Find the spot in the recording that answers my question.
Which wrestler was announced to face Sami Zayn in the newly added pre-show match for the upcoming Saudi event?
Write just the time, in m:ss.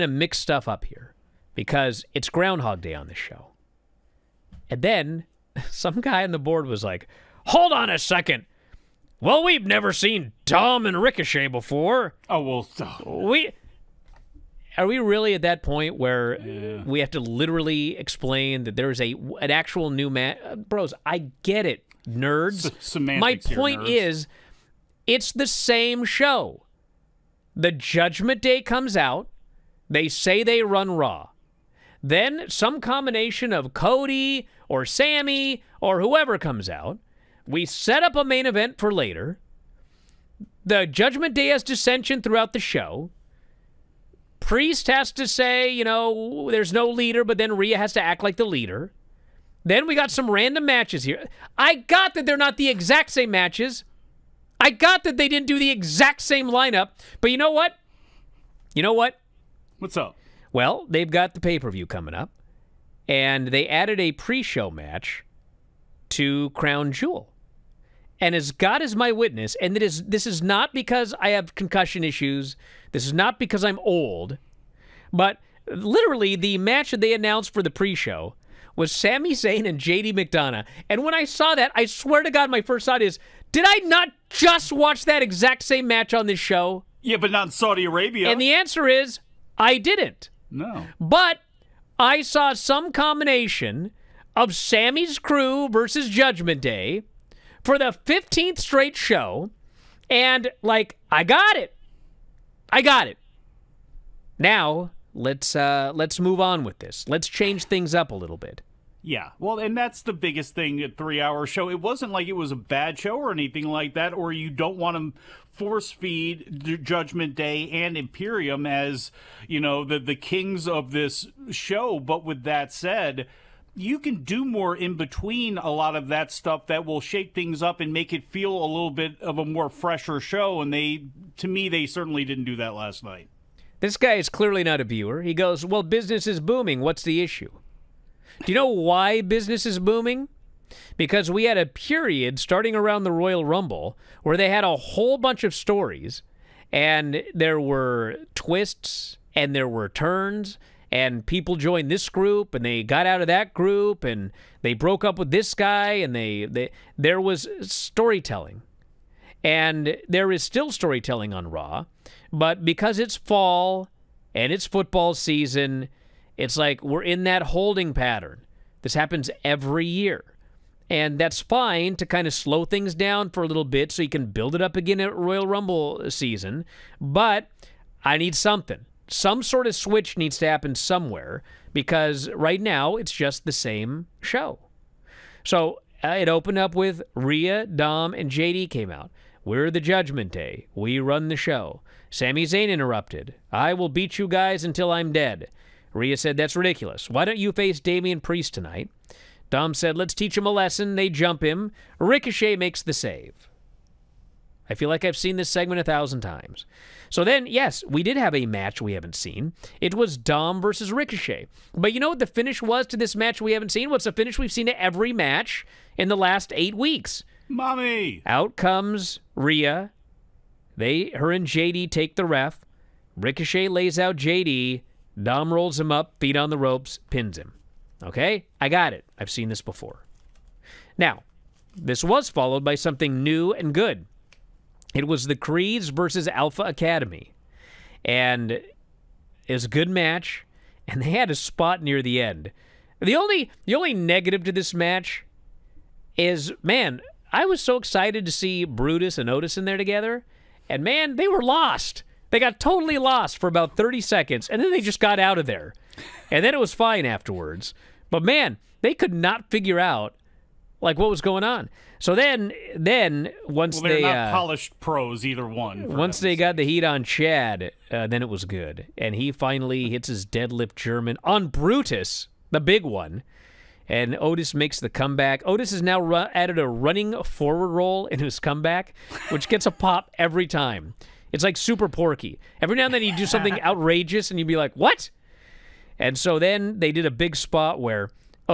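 1:19.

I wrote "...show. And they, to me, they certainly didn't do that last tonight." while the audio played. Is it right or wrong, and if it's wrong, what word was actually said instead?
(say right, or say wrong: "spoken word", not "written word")
wrong: "night", not "tonight".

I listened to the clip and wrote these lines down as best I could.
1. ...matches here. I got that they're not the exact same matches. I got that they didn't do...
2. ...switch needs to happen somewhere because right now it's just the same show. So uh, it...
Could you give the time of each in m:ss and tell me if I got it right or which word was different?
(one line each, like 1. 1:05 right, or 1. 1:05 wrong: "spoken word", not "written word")
1. 0:50 right
2. 2:59 right.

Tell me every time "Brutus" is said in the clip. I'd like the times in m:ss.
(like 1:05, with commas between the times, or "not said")
4:08, 4:31.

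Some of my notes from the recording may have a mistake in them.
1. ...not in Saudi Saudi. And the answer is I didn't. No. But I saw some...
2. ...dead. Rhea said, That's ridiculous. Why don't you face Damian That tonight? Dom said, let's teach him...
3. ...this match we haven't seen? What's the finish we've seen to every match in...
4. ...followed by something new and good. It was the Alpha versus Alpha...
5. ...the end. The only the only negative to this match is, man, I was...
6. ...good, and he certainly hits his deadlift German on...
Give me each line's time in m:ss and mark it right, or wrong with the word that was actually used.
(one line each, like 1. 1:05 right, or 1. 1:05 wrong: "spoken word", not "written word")
1. 1:27 wrong: "Arabia", not "Saudi"
2. 3:15 wrong: "Priest", not "That"
3. 3:32 right
4. 3:52 wrong: "Creeds", not "Alpha"
5. 4:02 right
6. 4:28 wrong: "finally", not "certainly".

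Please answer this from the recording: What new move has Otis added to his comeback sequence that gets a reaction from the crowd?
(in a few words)
running forward roll.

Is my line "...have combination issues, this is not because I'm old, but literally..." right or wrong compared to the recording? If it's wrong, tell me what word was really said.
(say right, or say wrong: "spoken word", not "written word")
wrong: "concussion", not "combination".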